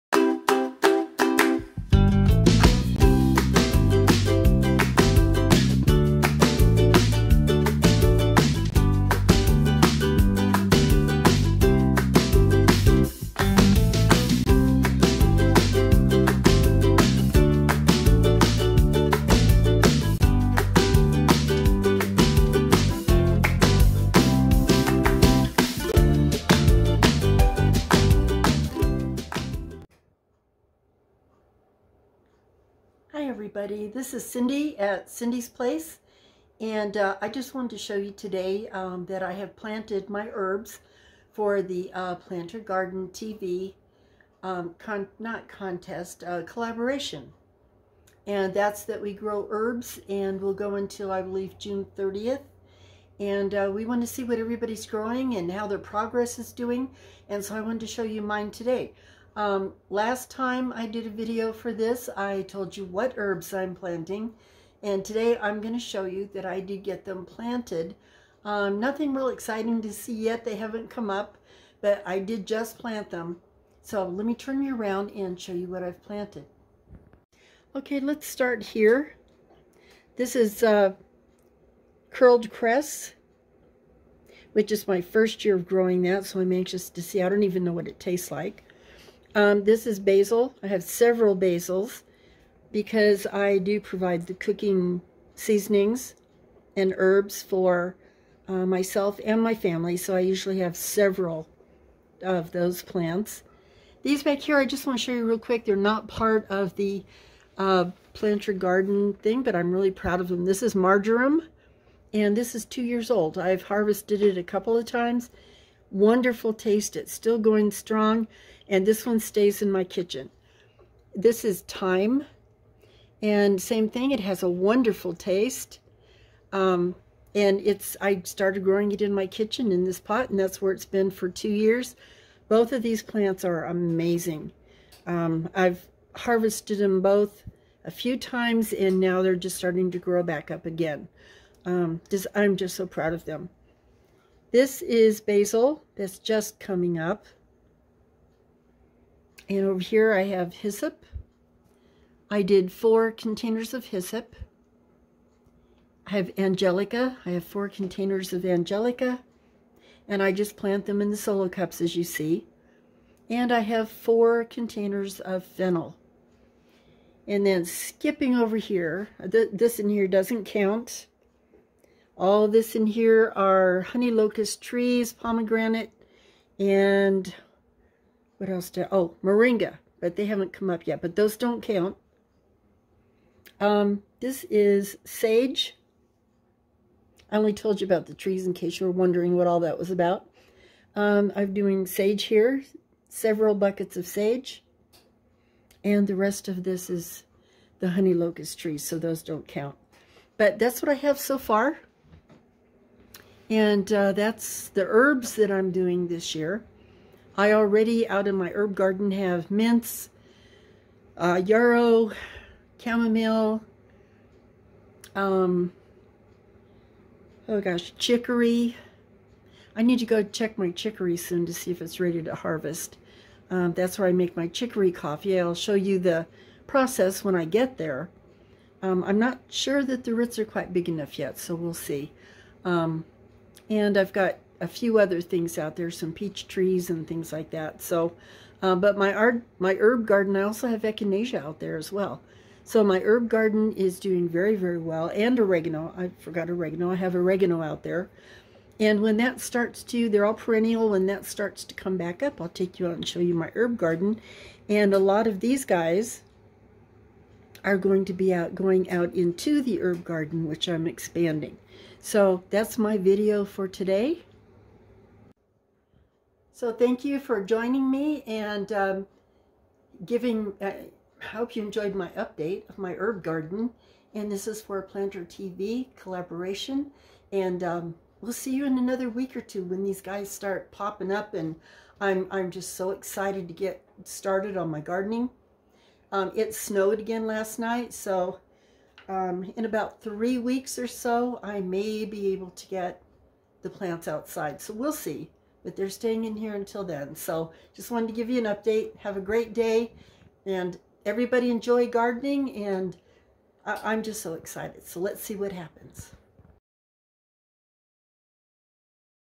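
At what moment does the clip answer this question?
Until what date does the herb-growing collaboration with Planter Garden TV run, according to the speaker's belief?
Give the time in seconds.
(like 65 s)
51 s.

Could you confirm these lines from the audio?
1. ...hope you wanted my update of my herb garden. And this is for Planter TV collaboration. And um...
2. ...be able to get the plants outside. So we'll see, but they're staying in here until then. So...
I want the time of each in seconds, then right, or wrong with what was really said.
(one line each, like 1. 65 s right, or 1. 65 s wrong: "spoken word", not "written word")
1. 271 s wrong: "enjoyed", not "wanted"
2. 292 s right.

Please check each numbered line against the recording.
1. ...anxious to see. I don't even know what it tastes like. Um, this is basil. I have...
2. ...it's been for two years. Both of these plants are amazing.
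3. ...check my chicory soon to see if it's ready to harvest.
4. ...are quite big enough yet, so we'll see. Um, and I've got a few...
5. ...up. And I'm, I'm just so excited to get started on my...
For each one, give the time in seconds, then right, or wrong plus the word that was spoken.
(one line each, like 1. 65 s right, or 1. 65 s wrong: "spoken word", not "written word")
1. 86 s right
2. 130 s right
3. 220 s right
4. 230 s right
5. 281 s right.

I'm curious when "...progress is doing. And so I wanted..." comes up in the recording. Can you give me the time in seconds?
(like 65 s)
55 s.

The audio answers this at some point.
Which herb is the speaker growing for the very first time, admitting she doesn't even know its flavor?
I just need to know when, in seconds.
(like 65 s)
82 s.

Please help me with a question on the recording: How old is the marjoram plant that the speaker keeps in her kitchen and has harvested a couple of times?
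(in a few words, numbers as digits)
2 years.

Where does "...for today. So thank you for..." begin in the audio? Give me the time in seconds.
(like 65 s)
263 s.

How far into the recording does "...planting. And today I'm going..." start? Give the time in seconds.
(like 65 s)
63 s.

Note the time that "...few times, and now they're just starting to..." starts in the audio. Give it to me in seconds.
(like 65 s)
137 s.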